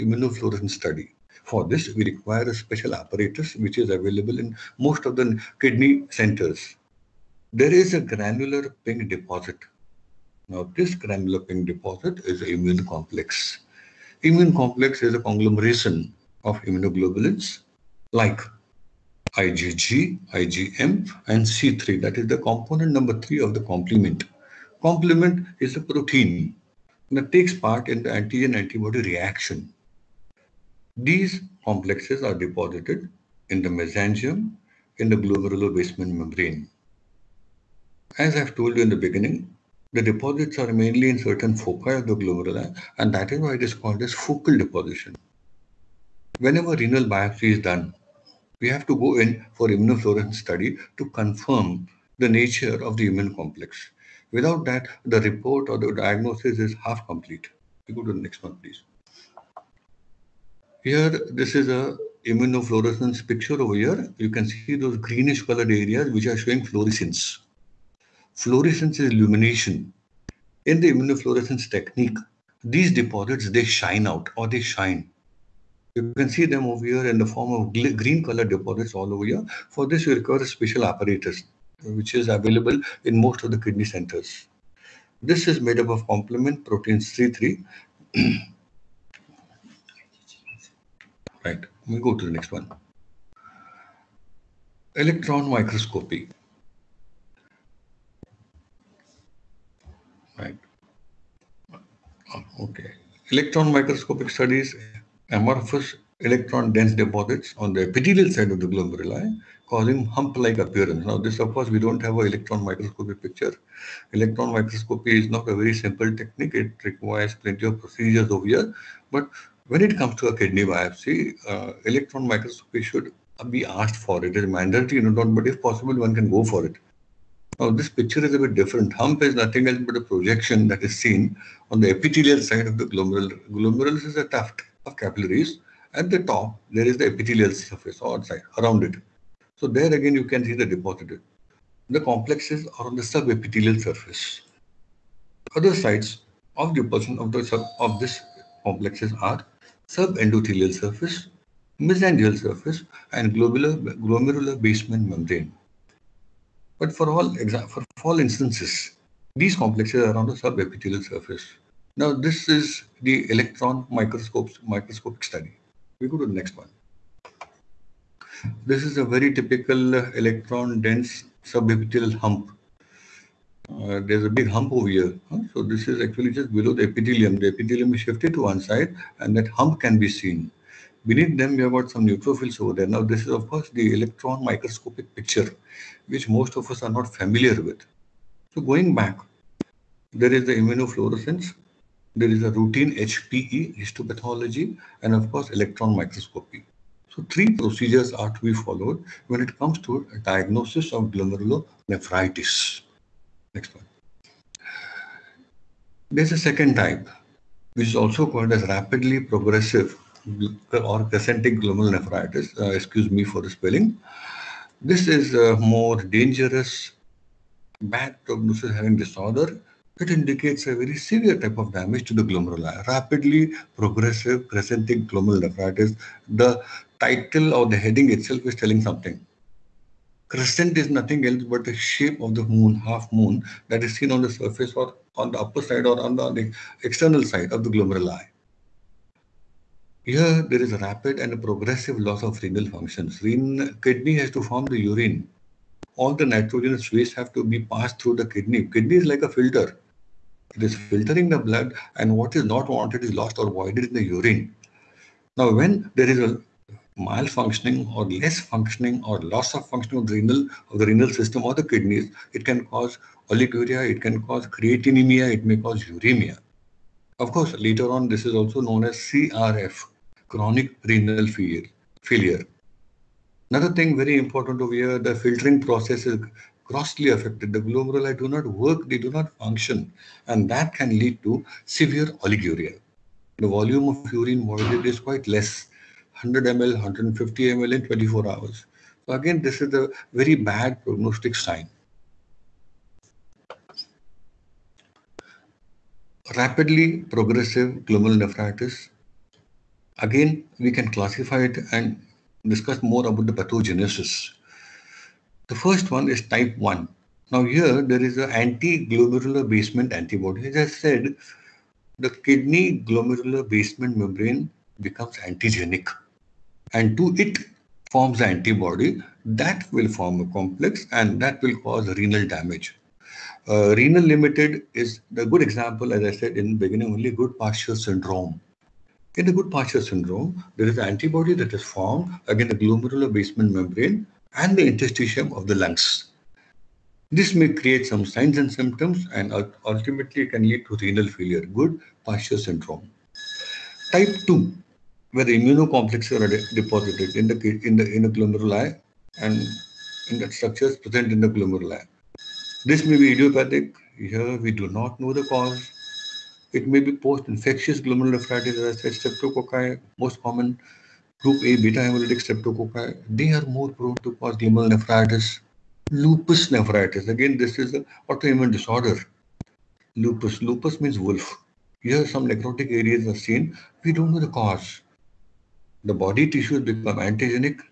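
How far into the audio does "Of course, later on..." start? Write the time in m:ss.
4:27.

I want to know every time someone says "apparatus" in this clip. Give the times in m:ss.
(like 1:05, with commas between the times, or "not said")
0:02, 1:20.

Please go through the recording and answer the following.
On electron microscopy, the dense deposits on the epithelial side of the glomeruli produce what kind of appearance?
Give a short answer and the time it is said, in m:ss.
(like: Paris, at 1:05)
Hump-like appearance, at 1:50.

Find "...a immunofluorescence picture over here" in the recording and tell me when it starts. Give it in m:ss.
1:01.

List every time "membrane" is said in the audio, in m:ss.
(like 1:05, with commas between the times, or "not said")
0:36, 2:35, 5:13, 5:33.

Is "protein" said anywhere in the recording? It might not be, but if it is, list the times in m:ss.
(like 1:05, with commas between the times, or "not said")
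0:25, 1:26.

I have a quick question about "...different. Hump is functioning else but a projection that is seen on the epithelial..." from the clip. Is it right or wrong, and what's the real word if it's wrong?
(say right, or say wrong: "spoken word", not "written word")
wrong: "nothing", not "functioning".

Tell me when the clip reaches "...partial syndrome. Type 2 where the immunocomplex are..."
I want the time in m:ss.
5:42.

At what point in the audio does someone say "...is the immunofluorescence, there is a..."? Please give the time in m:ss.
3:10.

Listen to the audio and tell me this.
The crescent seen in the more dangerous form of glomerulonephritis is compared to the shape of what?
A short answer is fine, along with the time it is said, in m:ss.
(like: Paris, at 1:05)
The moon, at 3:51.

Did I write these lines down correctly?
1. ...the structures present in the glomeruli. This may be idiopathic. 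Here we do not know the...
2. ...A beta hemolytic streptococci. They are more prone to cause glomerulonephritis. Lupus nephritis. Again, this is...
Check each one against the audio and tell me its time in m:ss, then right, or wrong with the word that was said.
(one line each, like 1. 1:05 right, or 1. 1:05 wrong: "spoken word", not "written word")
1. 5:50 right
2. 6:01 right.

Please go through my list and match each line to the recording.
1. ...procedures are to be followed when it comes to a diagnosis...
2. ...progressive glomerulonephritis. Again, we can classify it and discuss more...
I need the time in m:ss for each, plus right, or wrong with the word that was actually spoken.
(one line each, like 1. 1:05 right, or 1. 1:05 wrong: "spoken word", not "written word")
1. 3:17 right
2. 4:57 right.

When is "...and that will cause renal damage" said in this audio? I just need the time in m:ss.
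5:20.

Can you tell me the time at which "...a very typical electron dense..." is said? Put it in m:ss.
2:48.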